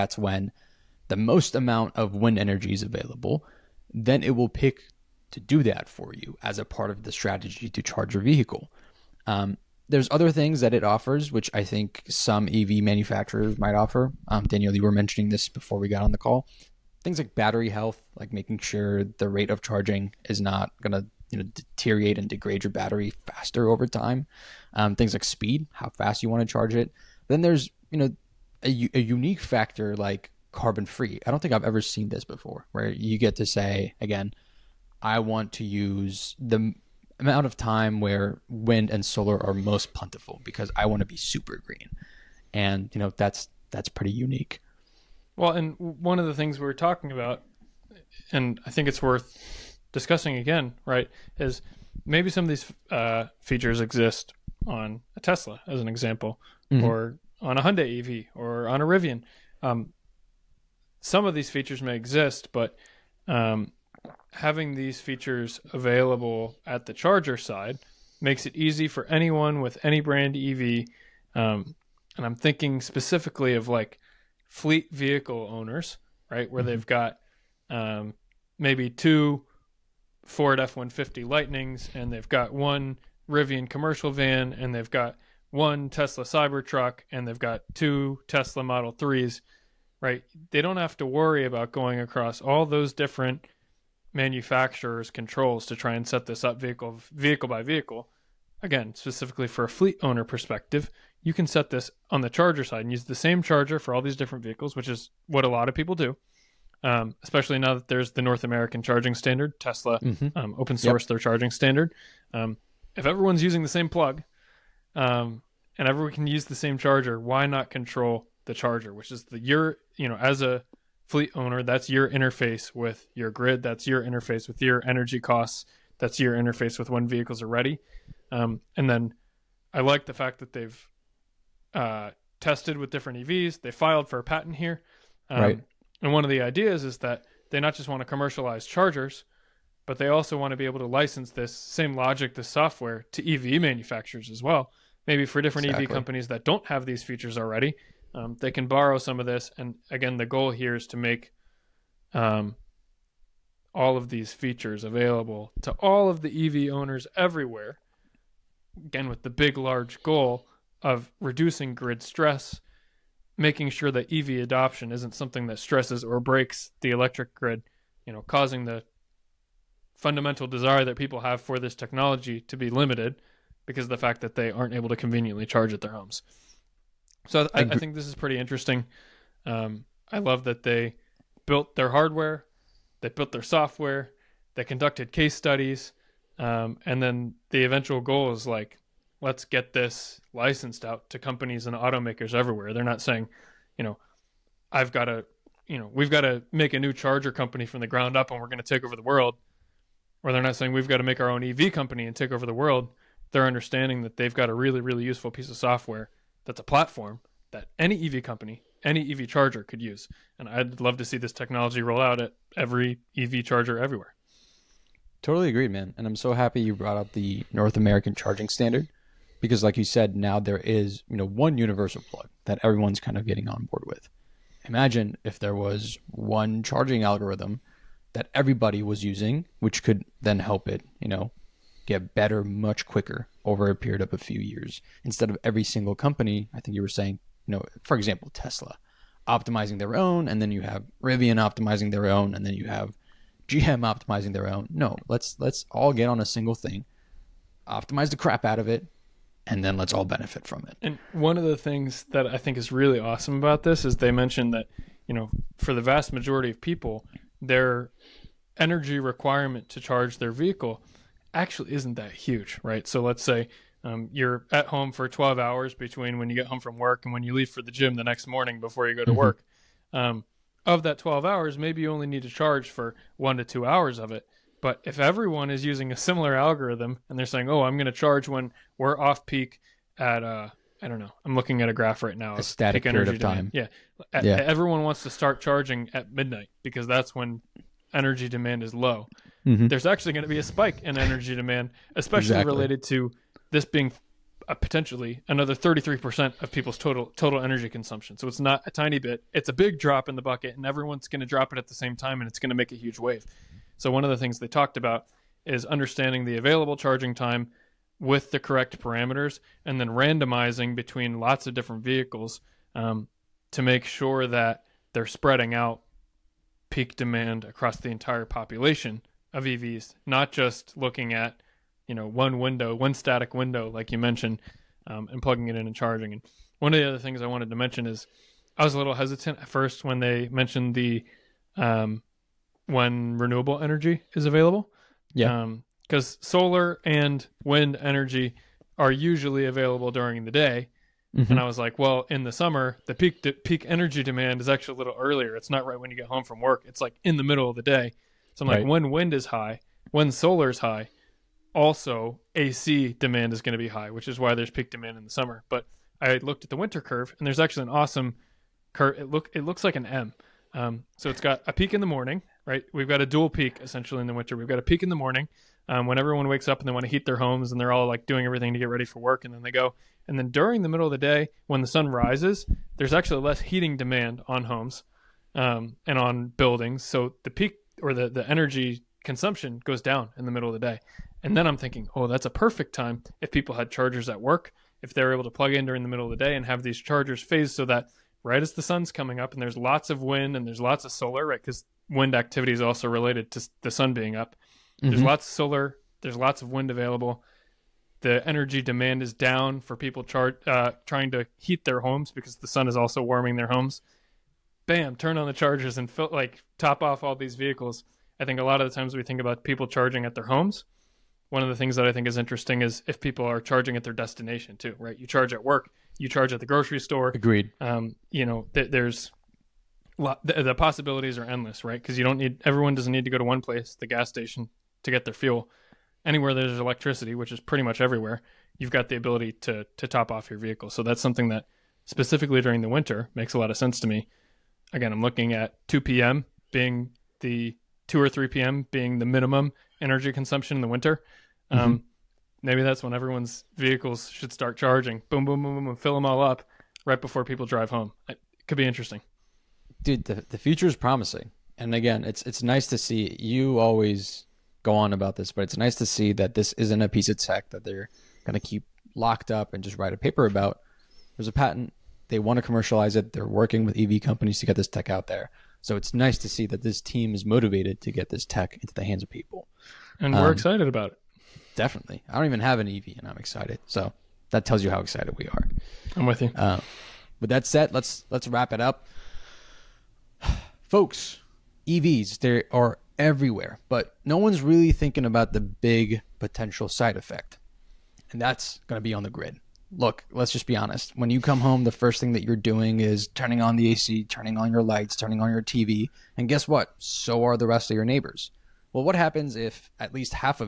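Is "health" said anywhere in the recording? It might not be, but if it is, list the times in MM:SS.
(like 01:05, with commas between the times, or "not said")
00:17.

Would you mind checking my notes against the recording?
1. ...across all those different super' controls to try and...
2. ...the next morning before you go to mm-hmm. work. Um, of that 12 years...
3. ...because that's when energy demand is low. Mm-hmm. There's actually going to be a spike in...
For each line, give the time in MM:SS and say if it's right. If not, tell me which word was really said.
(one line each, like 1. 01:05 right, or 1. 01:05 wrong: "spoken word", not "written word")
1. 01:31 wrong: "manufacturers", not "super"
2. 04:27 wrong: "hours", not "years"
3. 04:46 right.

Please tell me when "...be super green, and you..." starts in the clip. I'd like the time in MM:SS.
00:41.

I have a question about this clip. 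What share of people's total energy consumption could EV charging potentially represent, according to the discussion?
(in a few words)
33%.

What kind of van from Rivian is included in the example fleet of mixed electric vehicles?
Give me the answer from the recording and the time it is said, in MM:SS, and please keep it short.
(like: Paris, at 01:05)
Commercial van, at 01:23.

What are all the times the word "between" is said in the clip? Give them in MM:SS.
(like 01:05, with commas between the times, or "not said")
04:25, 05:10.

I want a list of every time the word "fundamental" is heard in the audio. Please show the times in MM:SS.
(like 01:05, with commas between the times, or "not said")
02:49.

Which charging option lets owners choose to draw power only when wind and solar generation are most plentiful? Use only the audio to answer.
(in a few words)
Carbon free.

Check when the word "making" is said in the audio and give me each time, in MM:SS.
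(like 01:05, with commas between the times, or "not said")
00:18, 02:43.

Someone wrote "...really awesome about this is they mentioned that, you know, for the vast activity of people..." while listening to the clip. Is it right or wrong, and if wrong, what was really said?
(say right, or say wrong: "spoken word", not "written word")
wrong: "majority", not "activity".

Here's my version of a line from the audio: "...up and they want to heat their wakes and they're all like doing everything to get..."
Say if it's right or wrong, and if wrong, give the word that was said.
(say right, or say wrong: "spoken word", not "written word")
wrong: "homes", not "wakes".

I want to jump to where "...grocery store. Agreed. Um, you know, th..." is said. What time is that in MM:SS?
06:56.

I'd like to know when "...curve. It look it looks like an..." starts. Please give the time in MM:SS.
05:58.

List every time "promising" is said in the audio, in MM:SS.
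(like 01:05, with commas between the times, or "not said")
07:30.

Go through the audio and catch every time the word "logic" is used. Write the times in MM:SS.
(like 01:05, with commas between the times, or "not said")
02:21.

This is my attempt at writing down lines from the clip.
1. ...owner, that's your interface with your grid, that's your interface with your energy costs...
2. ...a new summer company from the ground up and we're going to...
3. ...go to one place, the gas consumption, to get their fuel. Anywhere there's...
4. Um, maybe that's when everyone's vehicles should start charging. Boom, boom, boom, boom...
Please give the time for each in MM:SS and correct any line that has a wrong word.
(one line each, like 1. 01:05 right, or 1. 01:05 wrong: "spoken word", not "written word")
1. 02:01 right
2. 03:16 wrong: "charger", not "summer"
3. 07:03 wrong: "station", not "consumption"
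4. 07:21 right.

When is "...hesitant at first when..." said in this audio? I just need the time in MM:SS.
05:28.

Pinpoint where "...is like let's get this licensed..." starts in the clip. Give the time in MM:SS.
03:08.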